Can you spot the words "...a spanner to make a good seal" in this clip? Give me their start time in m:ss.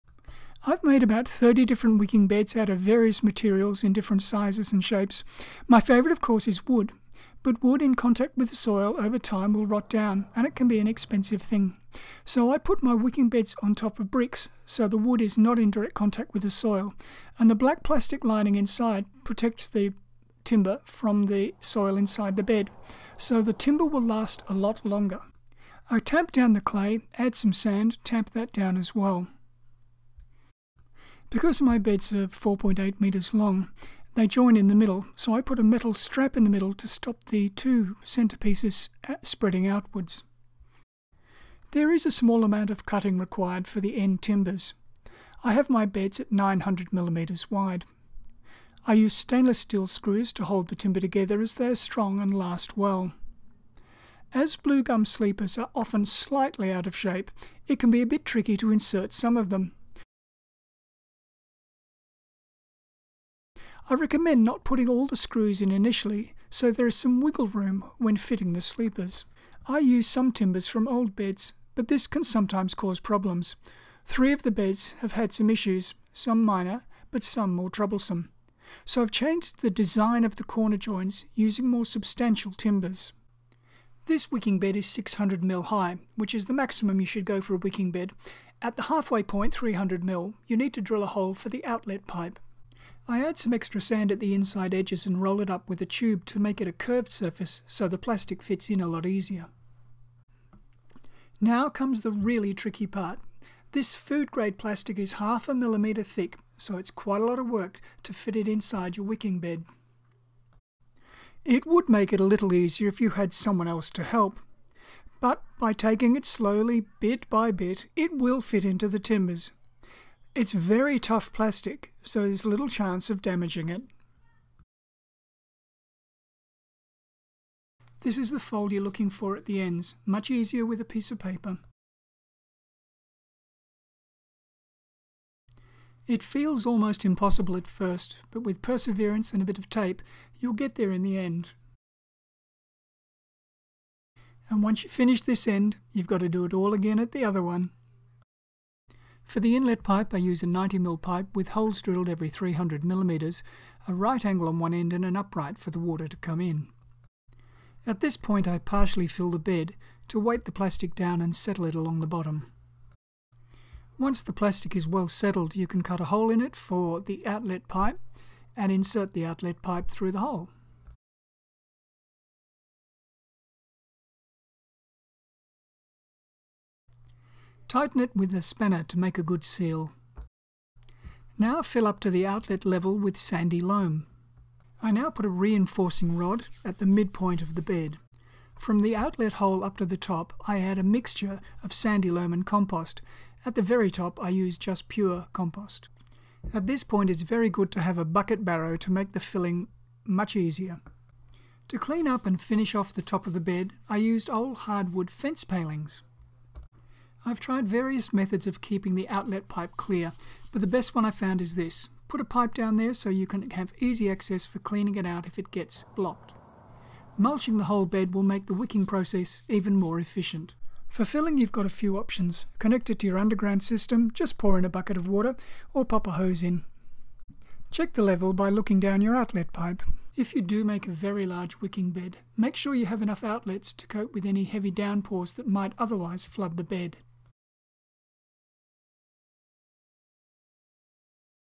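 2:58.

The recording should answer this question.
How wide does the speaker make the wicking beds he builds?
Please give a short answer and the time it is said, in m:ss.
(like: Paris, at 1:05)
900 millimetres, at 0:46.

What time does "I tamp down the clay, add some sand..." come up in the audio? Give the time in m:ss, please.
0:25.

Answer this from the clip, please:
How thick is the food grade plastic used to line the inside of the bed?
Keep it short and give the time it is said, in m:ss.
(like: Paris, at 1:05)
half a millimetre, at 1:45.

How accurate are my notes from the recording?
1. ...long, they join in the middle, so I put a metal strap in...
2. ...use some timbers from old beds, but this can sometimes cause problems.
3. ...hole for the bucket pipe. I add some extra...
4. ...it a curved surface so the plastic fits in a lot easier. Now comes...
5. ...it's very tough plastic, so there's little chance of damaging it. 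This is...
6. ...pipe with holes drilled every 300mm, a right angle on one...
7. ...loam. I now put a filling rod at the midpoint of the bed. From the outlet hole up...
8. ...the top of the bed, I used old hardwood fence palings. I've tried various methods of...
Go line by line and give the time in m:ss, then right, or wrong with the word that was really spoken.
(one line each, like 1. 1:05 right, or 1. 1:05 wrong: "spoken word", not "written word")
1. 0:33 right
2. 1:09 right
3. 1:31 wrong: "outlet", not "bucket"
4. 1:36 right
5. 2:00 right
6. 2:31 right
7. 3:03 wrong: "reinforcing", not "filling"
8. 3:22 right.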